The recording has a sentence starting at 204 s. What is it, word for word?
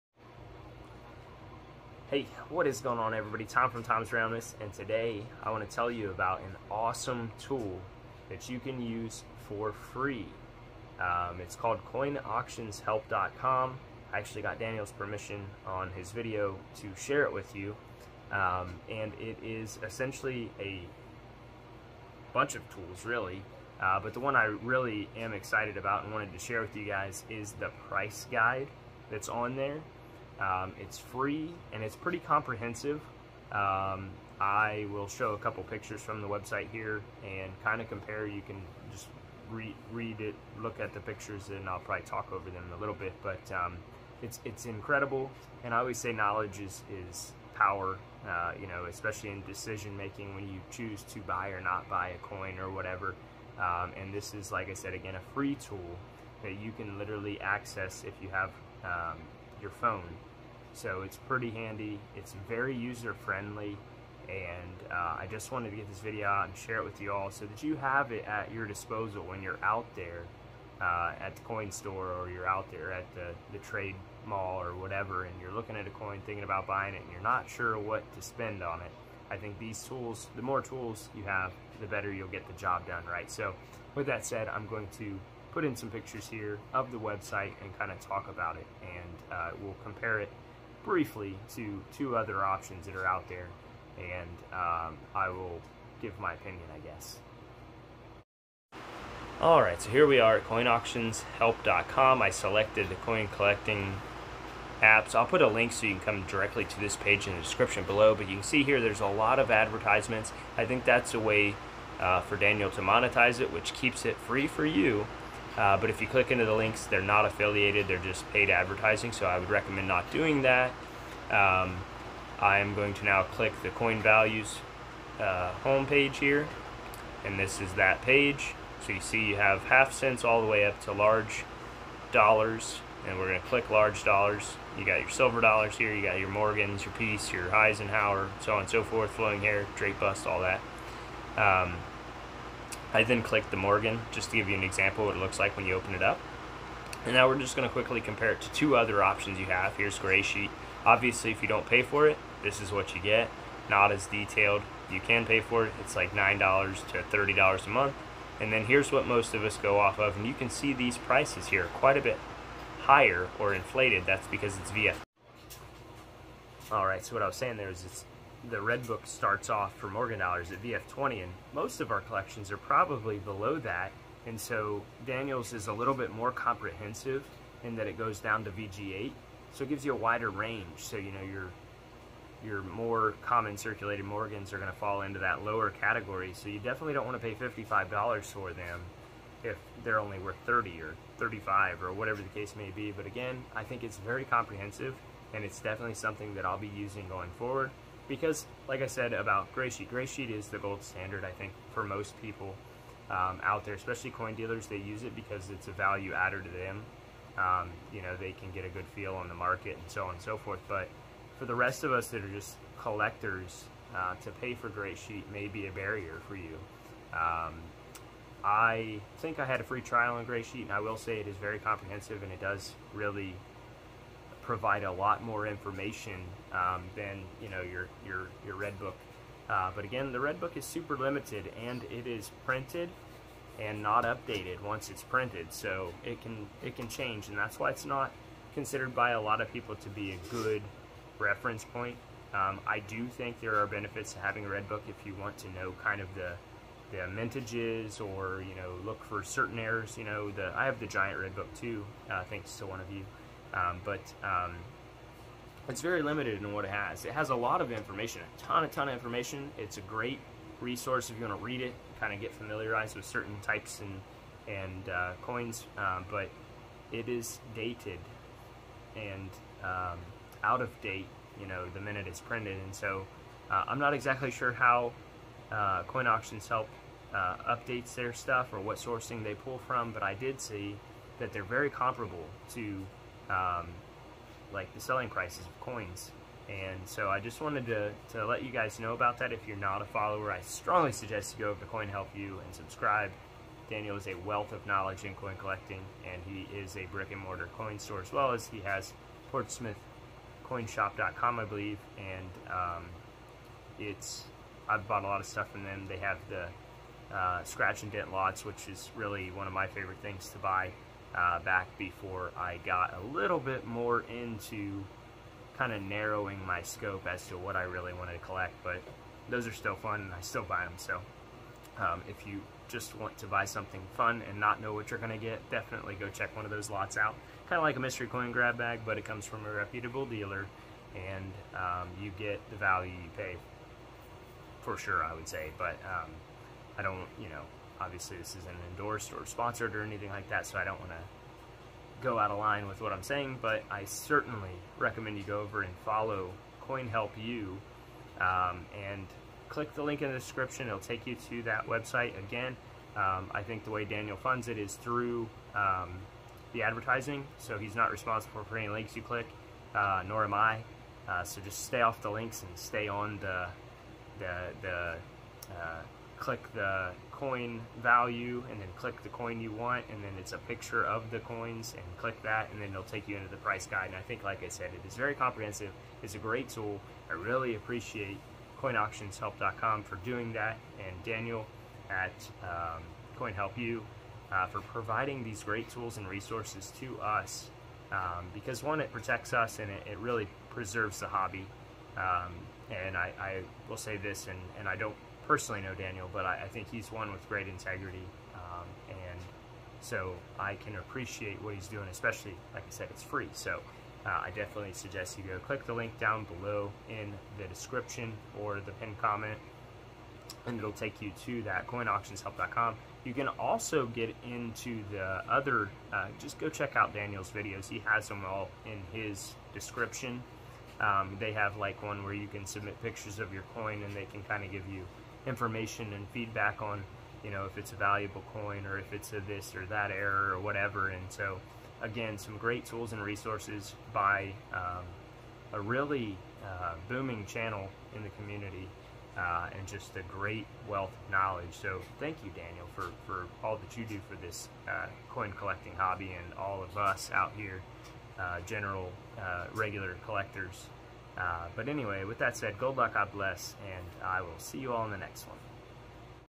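They use it because it's a value adder to them.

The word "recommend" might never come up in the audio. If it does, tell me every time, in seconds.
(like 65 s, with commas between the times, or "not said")
119 s, 344 s.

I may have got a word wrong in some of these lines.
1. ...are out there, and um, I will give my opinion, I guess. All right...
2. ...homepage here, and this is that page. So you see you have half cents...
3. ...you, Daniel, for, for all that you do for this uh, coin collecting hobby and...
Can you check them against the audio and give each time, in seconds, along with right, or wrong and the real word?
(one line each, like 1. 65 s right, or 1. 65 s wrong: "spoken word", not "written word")
1. 92 s right
2. 125 s right
3. 442 s right.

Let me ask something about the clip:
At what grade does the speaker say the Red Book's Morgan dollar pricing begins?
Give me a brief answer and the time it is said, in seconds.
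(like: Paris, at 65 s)
VF20, at 170 s.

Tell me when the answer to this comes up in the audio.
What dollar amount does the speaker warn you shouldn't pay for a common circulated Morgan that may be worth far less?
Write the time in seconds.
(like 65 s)
187 s.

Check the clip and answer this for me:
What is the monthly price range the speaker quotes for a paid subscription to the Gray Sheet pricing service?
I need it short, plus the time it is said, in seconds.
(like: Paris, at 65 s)
$9 to $30, at 156 s.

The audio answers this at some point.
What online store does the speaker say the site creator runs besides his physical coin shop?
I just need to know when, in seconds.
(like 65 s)
299 s.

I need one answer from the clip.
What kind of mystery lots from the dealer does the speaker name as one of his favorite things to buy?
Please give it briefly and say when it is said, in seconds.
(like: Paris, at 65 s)
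Scratch and dent lots, at 307 s.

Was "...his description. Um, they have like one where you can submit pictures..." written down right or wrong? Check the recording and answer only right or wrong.
right.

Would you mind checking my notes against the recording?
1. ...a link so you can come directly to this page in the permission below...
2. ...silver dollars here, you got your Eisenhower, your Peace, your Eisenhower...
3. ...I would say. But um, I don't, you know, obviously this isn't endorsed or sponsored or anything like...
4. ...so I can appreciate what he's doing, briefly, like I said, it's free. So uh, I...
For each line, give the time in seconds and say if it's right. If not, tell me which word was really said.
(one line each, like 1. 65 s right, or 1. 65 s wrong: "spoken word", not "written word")
1. 105 s wrong: "description", not "permission"
2. 135 s wrong: "Morgans", not "Eisenhower"
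3. 335 s right
4. 399 s wrong: "especially", not "briefly".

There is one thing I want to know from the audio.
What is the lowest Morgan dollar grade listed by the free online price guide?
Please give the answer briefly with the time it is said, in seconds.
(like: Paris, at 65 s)
VG8, at 178 s.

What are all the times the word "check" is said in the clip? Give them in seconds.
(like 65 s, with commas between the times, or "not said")
326 s, 416 s.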